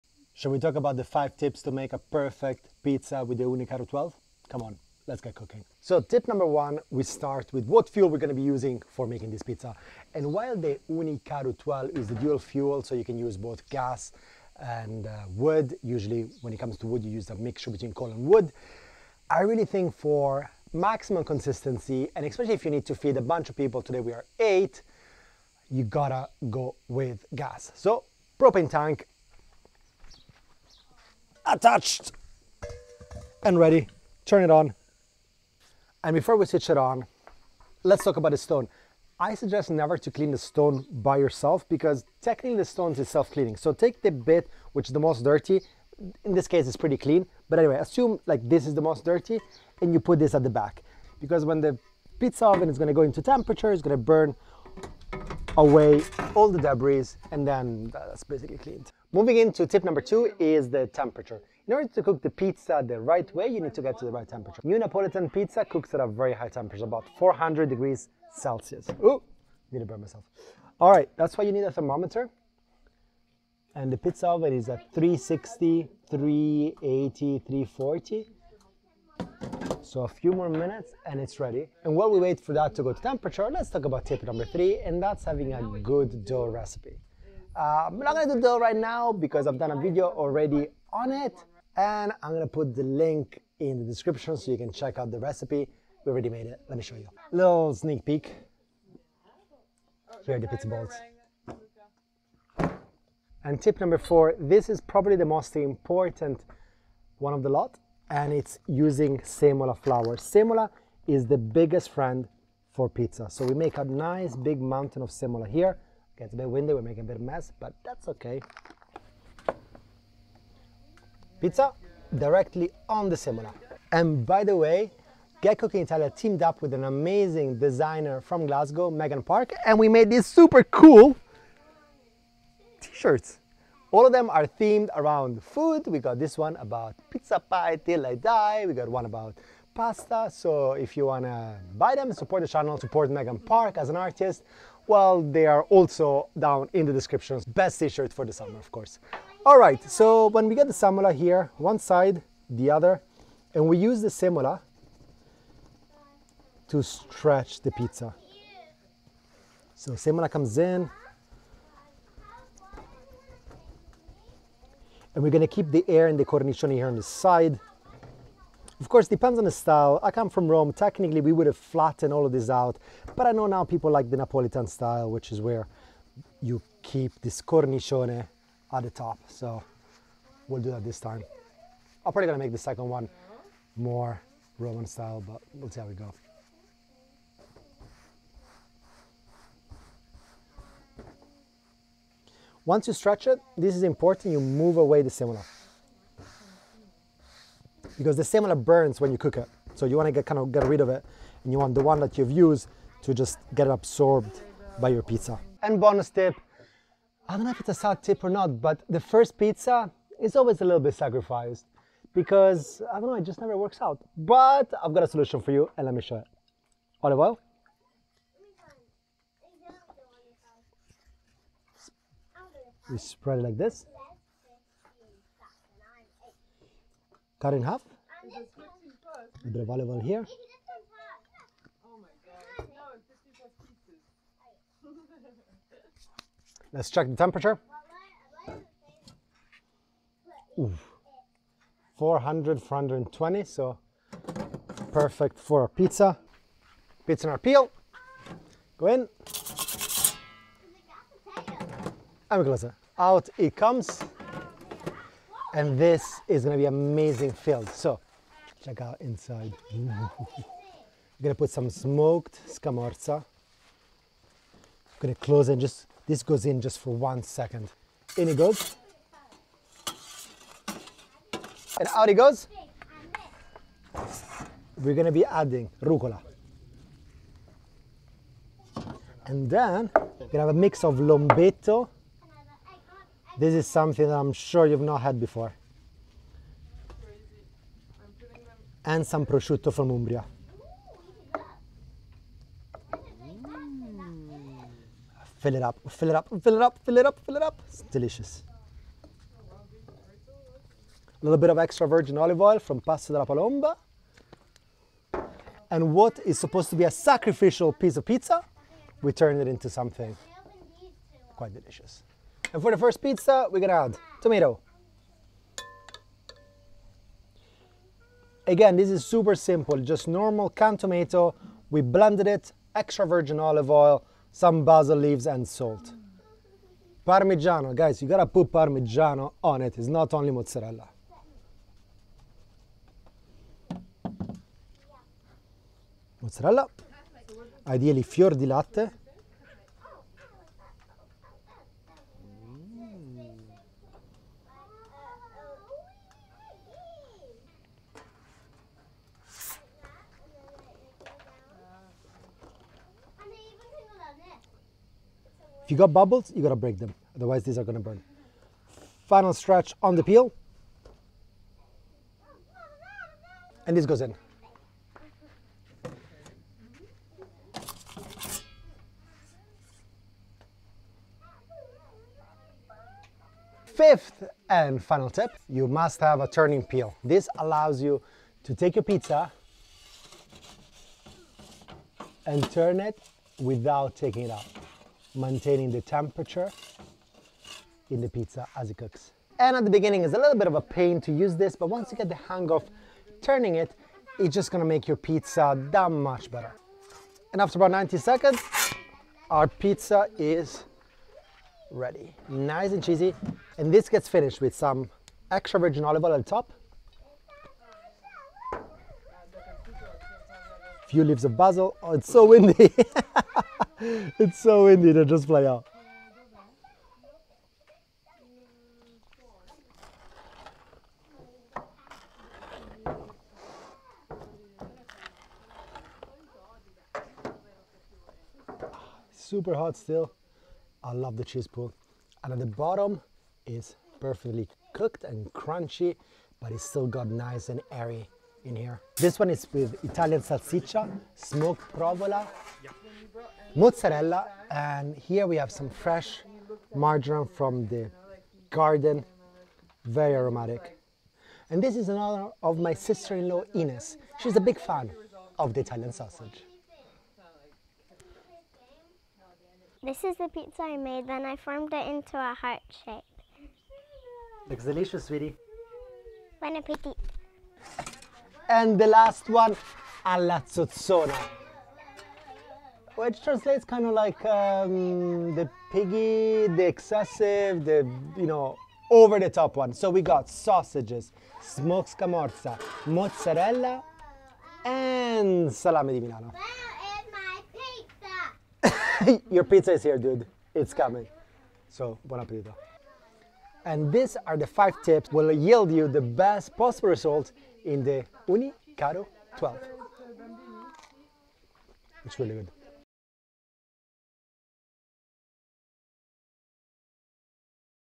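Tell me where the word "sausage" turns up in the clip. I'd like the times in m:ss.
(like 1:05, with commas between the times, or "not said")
7:35, 8:00.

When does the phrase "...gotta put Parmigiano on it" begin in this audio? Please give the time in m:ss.
5:28.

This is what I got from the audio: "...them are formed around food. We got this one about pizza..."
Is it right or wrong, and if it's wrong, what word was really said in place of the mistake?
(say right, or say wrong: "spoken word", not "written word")
wrong: "themed", not "formed".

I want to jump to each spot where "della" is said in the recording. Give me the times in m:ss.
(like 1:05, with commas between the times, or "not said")
5:03.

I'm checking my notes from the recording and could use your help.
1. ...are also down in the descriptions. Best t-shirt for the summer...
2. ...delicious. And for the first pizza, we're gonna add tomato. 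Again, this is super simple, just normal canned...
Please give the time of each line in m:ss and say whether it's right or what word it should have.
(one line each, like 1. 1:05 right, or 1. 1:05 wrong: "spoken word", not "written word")
1. 2:25 right
2. 5:11 right.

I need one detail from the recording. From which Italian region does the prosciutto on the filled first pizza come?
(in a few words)
Umbria.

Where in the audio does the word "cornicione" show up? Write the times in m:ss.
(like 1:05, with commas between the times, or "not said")
2:46, 2:57.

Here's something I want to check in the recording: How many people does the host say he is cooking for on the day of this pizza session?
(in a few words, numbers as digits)
8.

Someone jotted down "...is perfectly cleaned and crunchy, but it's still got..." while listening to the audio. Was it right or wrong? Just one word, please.
wrong.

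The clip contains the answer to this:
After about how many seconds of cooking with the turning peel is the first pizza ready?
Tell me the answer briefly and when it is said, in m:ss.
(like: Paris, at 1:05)
90 seconds, at 6:37.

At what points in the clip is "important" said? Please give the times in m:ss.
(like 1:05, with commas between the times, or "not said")
1:45, 3:13.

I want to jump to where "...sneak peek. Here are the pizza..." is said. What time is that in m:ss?
1:37.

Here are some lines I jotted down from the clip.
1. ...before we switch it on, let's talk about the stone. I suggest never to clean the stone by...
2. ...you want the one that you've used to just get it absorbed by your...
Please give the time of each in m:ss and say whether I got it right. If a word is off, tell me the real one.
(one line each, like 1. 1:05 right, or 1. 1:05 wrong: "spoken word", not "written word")
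1. 0:36 right
2. 3:21 right.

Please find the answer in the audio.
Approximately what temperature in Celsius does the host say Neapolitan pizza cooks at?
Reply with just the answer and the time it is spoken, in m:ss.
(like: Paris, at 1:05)
400 degrees Celsius, at 1:07.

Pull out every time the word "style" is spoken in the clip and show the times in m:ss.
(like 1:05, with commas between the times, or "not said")
2:49, 2:54, 3:04.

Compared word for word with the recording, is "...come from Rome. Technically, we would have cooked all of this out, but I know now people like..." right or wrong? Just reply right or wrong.
wrong.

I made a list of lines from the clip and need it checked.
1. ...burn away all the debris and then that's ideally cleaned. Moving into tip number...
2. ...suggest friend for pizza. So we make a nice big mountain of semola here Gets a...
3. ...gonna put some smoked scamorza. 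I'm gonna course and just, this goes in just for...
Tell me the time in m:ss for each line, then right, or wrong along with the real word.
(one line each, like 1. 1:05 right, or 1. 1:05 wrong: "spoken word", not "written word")
1. 0:53 wrong: "basically", not "ideally"
2. 1:51 wrong: "biggest", not "suggest"
3. 4:21 wrong: "close", not "course".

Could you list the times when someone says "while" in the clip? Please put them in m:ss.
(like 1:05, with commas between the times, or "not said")
0:10, 1:21.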